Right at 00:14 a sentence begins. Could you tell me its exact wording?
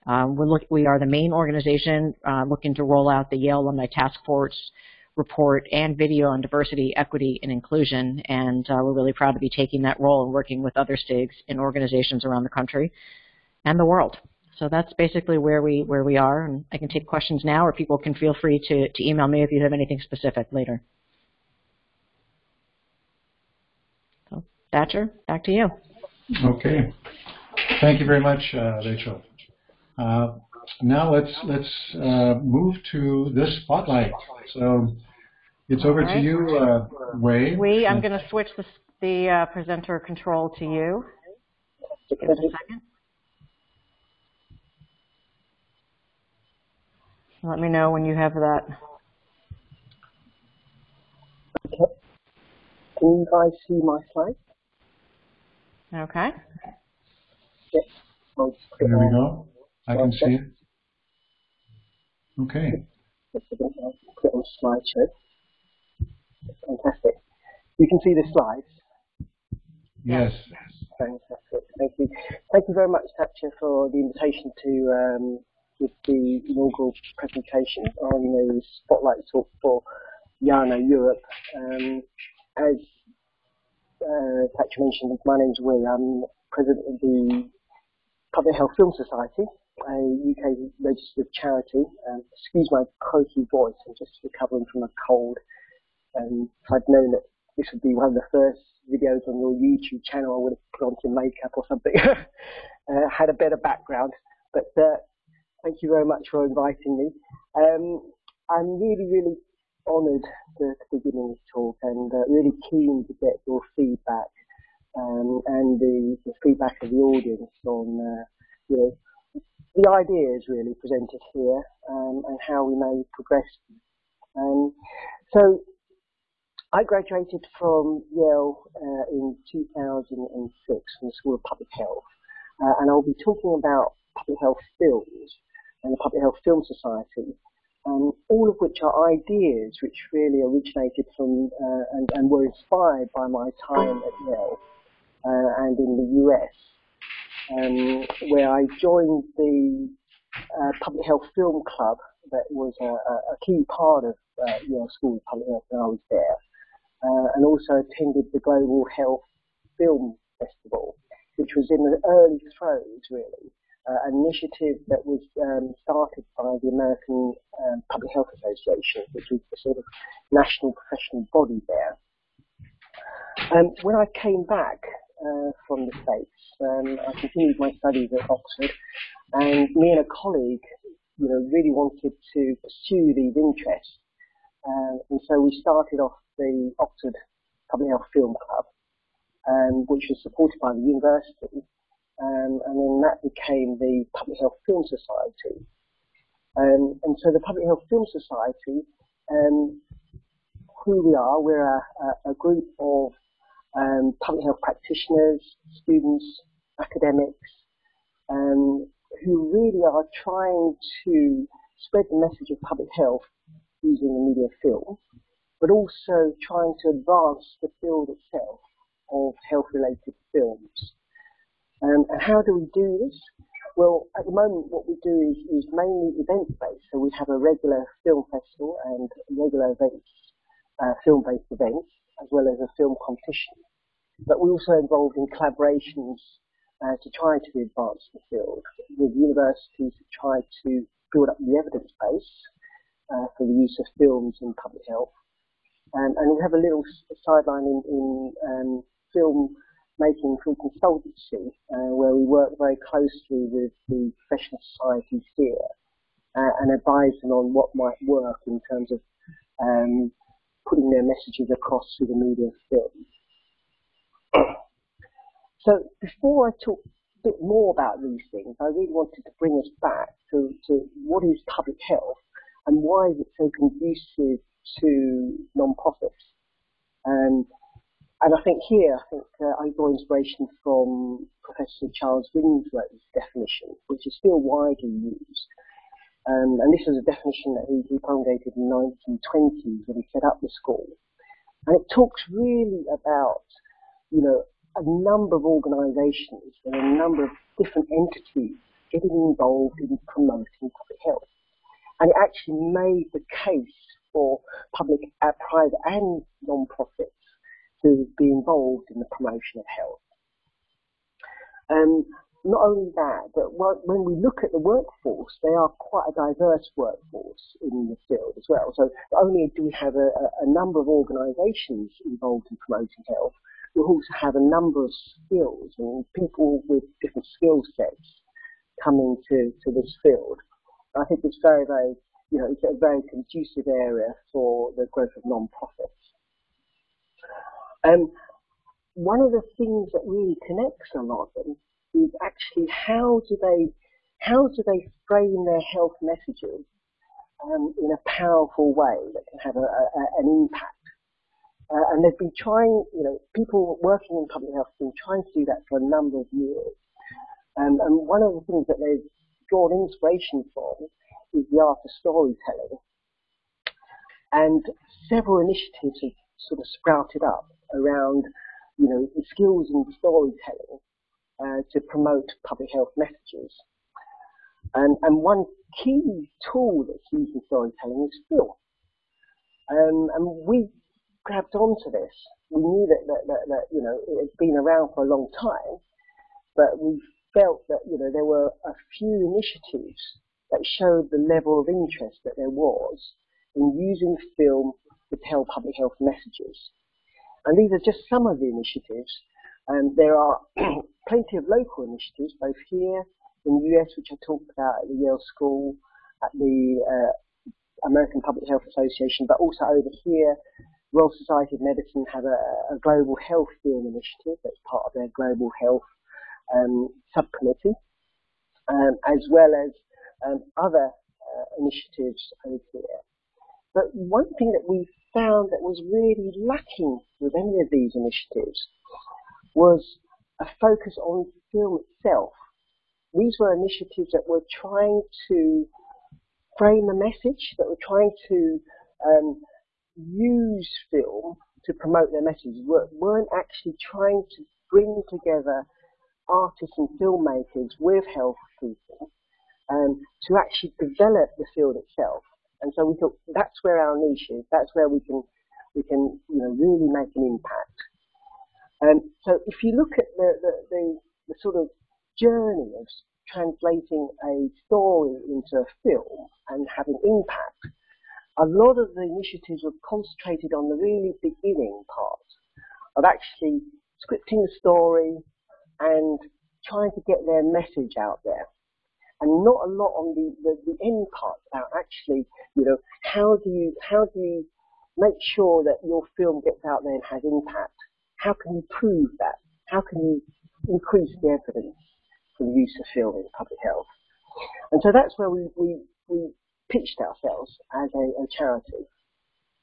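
So that's basically where we where we are.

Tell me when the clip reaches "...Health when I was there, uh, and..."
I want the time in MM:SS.
02:35.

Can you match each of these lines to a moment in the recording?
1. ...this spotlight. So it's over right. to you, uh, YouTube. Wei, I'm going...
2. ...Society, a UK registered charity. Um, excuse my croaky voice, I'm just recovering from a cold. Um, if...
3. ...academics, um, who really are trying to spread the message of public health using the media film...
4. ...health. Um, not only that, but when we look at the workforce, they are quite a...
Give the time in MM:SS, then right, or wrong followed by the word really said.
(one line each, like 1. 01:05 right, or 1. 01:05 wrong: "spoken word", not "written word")
1. 00:33 wrong: "Wei", not "YouTube"
2. 01:28 right
3. 03:26 right
4. 05:09 right.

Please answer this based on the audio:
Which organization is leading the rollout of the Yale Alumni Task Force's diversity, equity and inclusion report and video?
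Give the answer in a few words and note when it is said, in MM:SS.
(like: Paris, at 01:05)
the main organization, at 00:00.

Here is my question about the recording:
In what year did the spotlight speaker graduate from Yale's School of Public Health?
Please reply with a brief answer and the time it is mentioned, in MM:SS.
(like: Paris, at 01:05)
2006, at 02:09.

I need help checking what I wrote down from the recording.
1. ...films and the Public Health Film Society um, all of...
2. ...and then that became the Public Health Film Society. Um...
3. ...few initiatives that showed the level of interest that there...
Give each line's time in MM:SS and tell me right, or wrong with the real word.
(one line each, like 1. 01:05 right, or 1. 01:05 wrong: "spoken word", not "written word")
1. 02:14 right
2. 03:12 right
3. 06:28 right.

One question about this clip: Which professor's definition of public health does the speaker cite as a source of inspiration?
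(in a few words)
Charles Winslow.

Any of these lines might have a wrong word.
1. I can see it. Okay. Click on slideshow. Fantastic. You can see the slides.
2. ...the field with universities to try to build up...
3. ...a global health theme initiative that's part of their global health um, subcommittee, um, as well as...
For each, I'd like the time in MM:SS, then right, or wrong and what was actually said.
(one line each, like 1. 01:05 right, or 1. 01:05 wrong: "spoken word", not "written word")
1. 00:59 right
2. 03:58 right
3. 06:52 right.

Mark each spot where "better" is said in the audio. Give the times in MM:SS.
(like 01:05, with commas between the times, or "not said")
01:43.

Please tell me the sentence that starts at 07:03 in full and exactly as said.
But one thing that we found that was really lacking with any of these initiatives was a focus on film itself.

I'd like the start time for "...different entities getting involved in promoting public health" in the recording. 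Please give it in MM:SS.
04:57.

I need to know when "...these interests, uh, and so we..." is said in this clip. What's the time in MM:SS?
03:03.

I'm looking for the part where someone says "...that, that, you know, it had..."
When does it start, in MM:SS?
06:23.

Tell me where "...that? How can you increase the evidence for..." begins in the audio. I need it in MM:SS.
08:09.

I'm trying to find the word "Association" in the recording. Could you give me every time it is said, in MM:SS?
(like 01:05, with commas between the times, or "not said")
02:48, 06:48.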